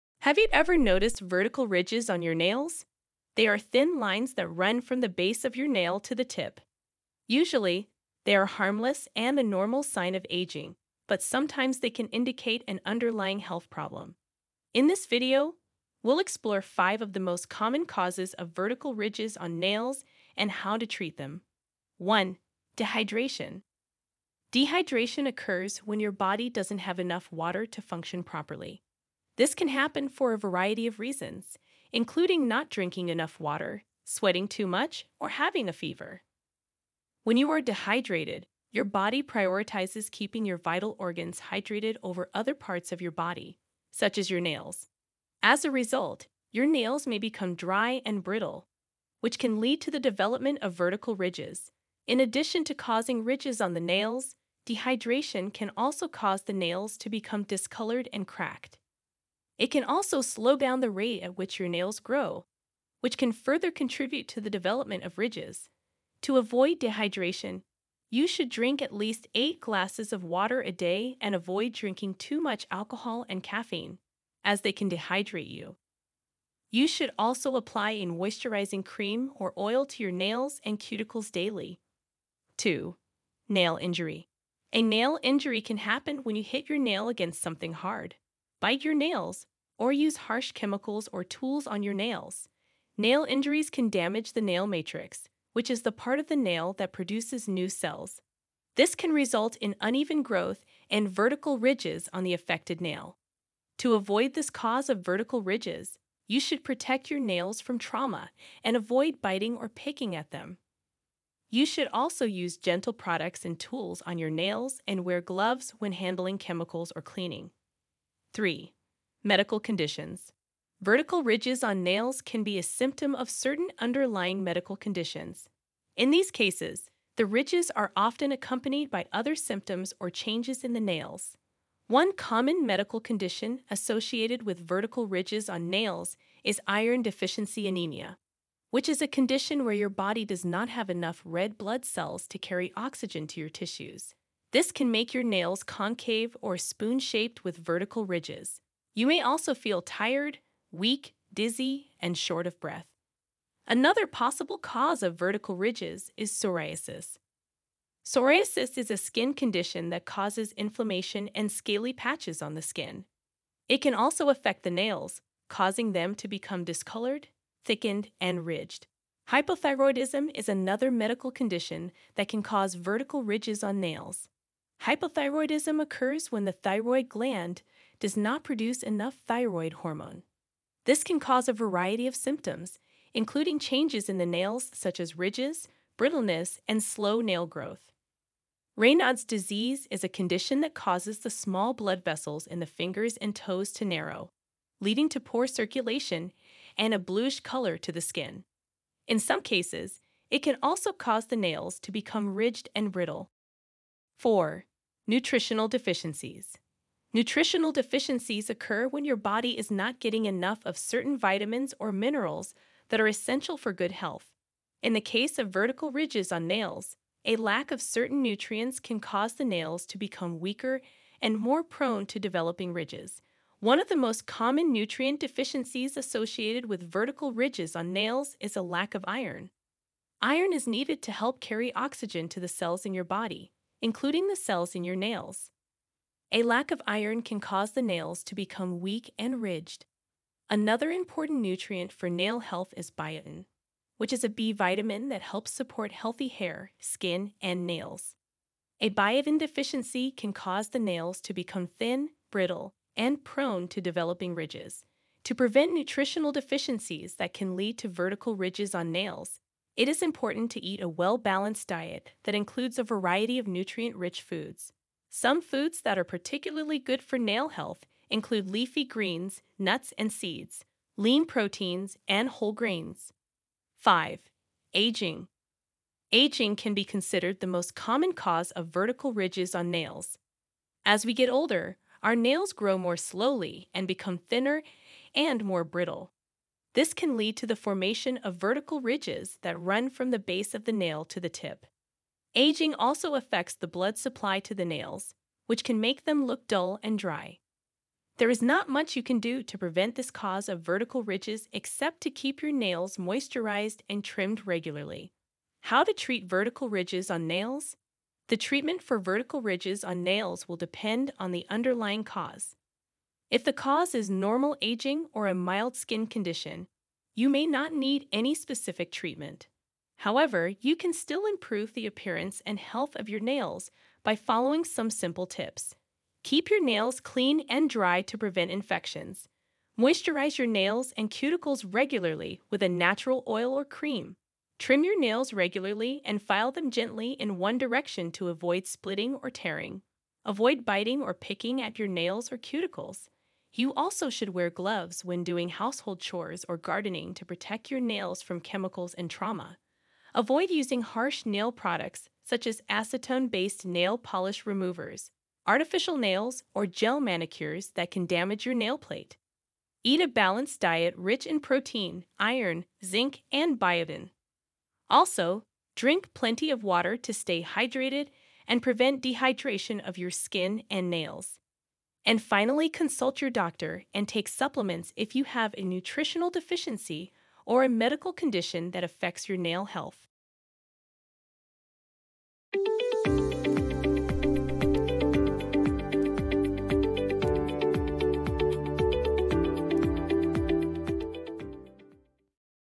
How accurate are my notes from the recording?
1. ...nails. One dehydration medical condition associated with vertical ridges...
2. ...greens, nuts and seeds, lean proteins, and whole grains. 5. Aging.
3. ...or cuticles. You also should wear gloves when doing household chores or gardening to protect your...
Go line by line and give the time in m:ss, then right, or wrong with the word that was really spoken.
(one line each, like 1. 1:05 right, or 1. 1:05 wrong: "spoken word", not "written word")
1. 2:10 wrong: "common", not "dehydration"
2. 4:28 right
3. 5:42 right.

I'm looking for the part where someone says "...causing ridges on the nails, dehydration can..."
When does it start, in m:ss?
0:52.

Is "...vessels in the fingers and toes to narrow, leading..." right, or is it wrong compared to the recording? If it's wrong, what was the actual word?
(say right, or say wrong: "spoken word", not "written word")
right.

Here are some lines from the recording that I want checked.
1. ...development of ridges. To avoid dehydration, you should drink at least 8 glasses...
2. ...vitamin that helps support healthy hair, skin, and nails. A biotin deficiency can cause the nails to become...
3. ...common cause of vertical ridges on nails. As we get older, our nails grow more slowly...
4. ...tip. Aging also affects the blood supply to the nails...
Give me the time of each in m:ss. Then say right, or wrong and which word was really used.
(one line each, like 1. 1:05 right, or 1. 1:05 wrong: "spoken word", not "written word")
1. 1:04 right
2. 4:04 right
3. 4:37 right
4. 4:51 right.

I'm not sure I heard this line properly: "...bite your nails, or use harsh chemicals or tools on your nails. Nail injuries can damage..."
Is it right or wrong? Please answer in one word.
right.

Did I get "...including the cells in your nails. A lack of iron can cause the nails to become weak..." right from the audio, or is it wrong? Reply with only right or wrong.
right.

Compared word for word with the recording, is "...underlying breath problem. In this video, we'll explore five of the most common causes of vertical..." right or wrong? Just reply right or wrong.
wrong.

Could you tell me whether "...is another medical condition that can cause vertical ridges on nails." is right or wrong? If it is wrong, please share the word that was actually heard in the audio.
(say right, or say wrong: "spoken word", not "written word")
right.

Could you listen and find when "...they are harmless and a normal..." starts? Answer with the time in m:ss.
0:08.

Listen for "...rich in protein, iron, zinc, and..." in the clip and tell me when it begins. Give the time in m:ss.
6:00.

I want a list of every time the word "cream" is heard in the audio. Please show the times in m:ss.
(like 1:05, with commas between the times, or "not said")
1:18, 5:33.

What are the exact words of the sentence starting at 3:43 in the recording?
One of the most common nutrient deficiencies associated with vertical ridges on nails is a lack of iron.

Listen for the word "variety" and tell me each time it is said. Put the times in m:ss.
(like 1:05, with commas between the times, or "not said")
0:30, 3:01, 4:22.